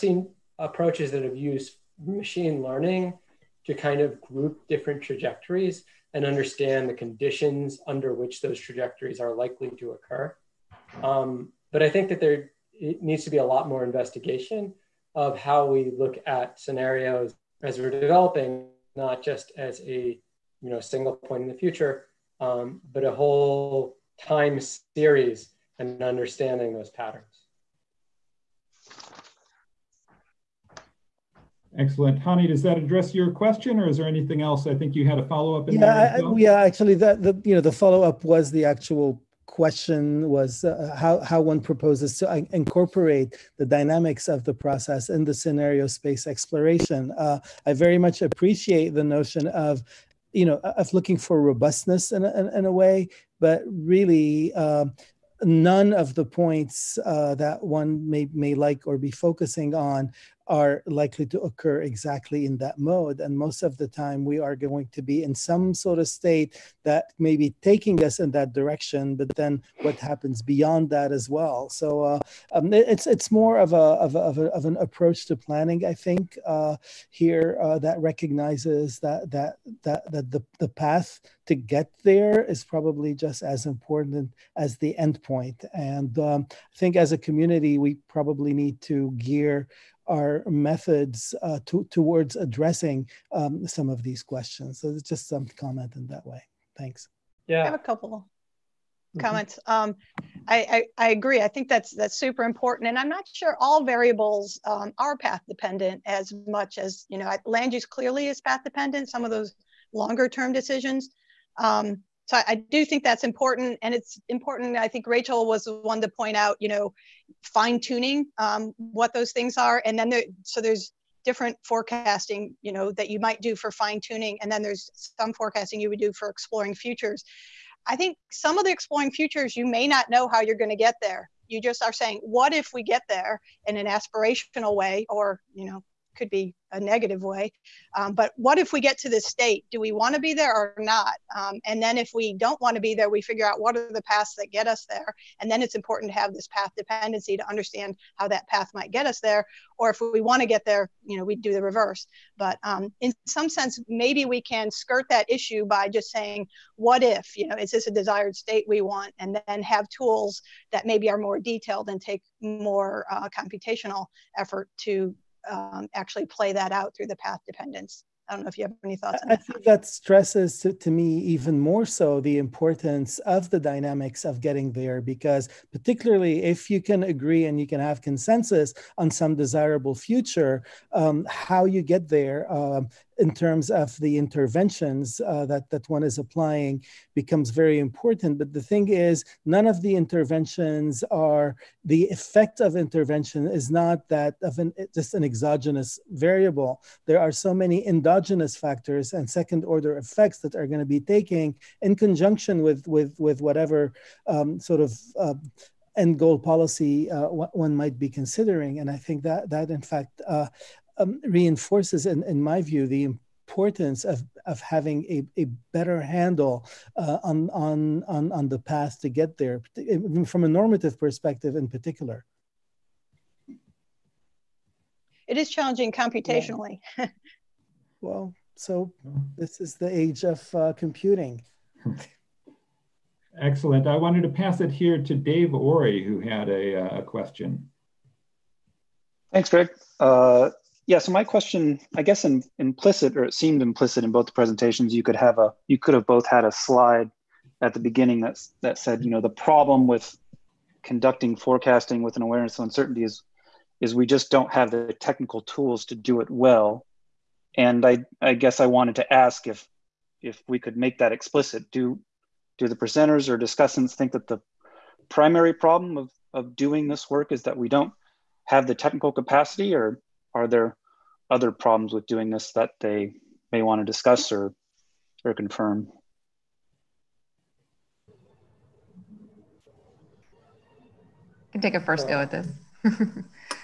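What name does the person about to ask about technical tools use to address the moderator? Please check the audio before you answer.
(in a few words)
Greg.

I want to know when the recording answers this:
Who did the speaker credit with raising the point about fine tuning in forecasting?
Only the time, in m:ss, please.
1:55.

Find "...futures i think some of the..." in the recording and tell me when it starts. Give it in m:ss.
2:06.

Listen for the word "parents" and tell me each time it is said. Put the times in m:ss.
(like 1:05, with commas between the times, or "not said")
not said.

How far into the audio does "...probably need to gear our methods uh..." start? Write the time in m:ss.
1:28.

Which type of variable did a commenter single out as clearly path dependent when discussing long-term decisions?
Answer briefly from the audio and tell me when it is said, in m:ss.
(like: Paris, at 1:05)
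Land use, at 1:47.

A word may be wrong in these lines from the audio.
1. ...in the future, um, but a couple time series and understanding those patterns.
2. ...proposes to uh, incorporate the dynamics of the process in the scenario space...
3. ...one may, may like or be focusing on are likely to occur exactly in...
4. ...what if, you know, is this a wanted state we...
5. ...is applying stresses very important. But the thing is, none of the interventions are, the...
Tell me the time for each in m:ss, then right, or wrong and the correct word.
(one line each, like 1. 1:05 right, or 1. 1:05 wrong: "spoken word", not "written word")
1. 0:21 wrong: "whole", not "couple"
2. 0:41 right
3. 0:57 right
4. 2:36 wrong: "desired", not "wanted"
5. 3:06 wrong: "becomes", not "stresses".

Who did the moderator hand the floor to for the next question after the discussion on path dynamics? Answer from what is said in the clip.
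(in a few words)
Dave Ori.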